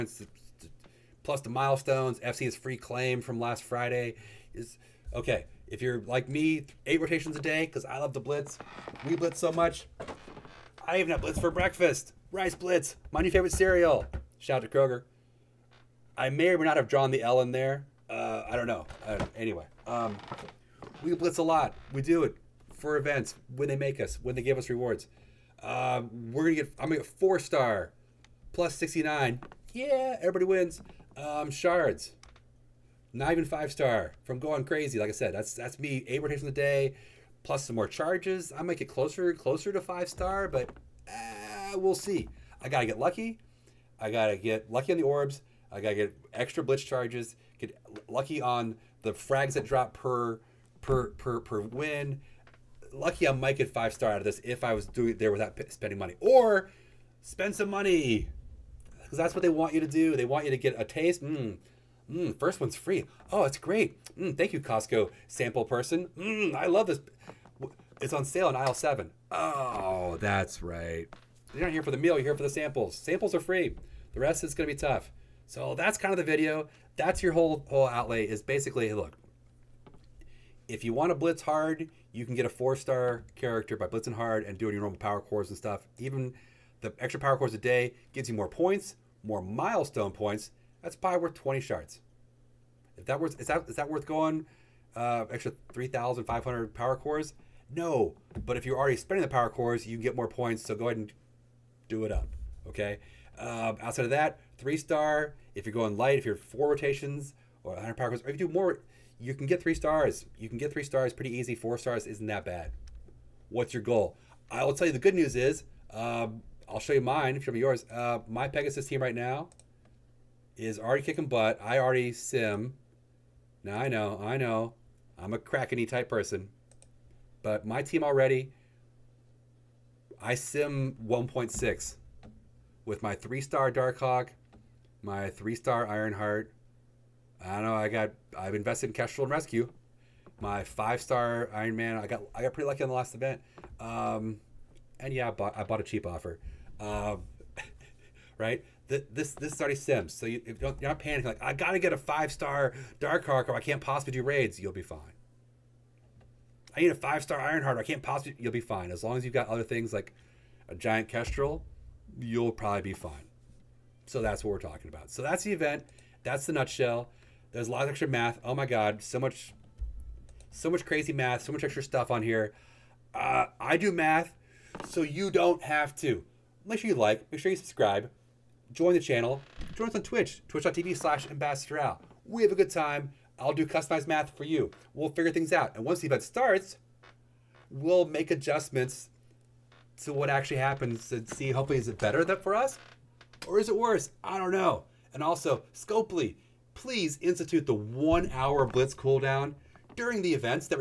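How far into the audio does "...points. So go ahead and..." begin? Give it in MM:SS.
01:40.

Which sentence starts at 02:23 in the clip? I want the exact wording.
Um, and yeah, I bought I bought a cheap offer.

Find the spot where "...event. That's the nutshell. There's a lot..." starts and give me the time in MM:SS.
02:45.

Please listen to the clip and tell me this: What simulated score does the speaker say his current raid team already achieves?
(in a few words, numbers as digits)
1.6.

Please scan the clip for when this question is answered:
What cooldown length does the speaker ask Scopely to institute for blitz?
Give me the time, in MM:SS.
03:17.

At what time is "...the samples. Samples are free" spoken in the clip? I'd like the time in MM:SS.
01:12.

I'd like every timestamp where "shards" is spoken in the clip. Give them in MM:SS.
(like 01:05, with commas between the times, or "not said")
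00:31, 01:31.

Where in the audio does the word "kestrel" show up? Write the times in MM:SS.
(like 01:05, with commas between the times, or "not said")
02:18, 02:41.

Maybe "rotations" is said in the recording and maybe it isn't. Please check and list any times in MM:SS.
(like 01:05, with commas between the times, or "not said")
00:07, 01:46.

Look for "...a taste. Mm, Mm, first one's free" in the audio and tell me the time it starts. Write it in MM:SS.
01:00.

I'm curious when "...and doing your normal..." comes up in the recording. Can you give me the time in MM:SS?
01:24.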